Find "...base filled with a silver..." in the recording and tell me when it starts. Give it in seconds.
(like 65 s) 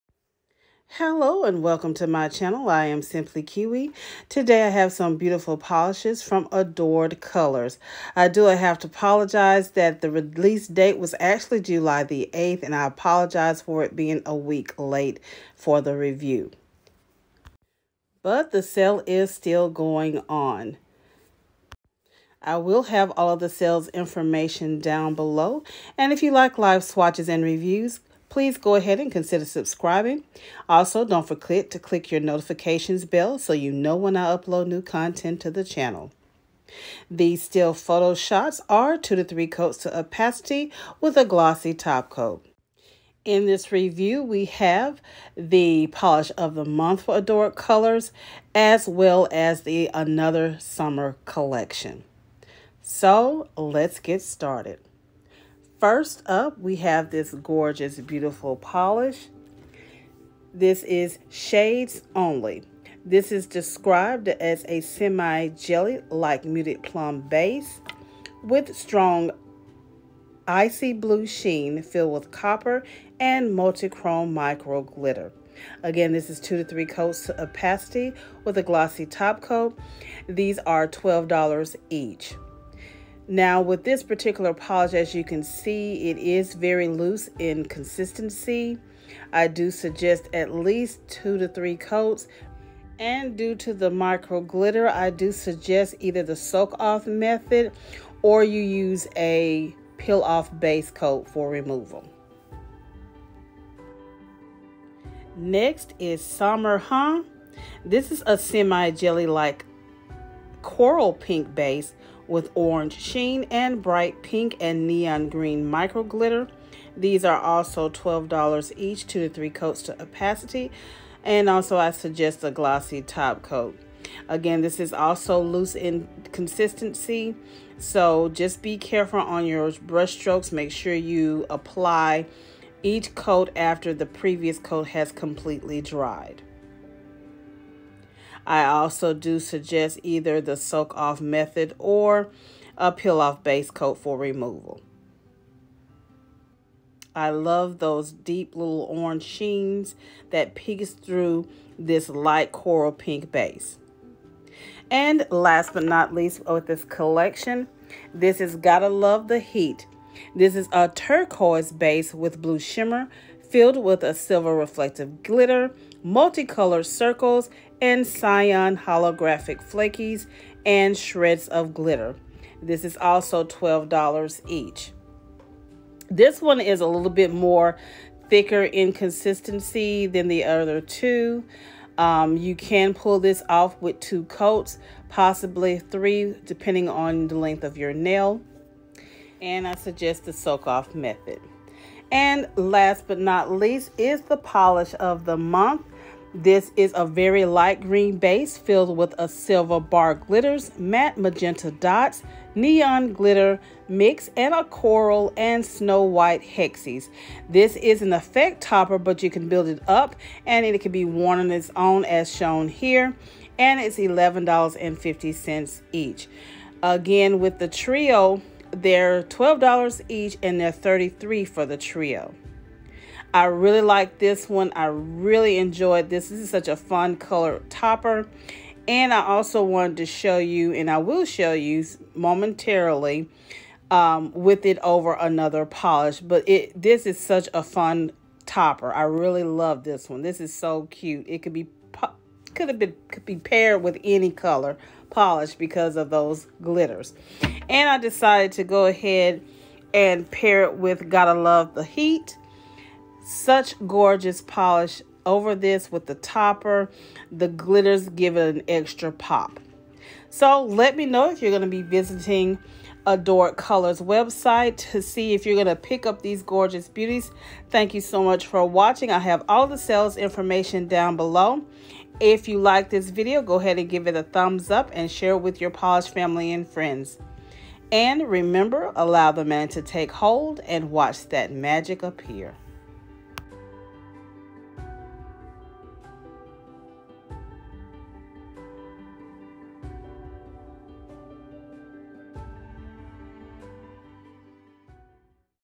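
198 s.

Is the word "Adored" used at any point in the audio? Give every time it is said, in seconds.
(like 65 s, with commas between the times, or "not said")
6 s, 47 s, 263 s.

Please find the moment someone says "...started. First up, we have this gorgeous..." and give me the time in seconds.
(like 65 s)
54 s.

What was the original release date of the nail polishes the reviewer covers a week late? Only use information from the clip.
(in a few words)
July 8th.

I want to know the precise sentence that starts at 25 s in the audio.
And if you like live swatches and reviews, please go ahead and consider subscribing.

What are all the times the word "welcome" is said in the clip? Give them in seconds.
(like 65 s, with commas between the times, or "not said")
1 s.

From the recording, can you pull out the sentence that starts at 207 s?
This is an effect topper, but you can build it up and it can be worn on its own as shown here.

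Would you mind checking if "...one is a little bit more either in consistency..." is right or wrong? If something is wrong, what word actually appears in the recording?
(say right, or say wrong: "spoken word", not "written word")
wrong: "thicker", not "either".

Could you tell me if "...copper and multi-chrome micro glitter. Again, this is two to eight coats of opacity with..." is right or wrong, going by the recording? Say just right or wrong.
wrong.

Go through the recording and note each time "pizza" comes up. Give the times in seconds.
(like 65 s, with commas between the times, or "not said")
not said.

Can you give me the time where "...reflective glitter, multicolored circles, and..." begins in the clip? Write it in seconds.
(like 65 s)
164 s.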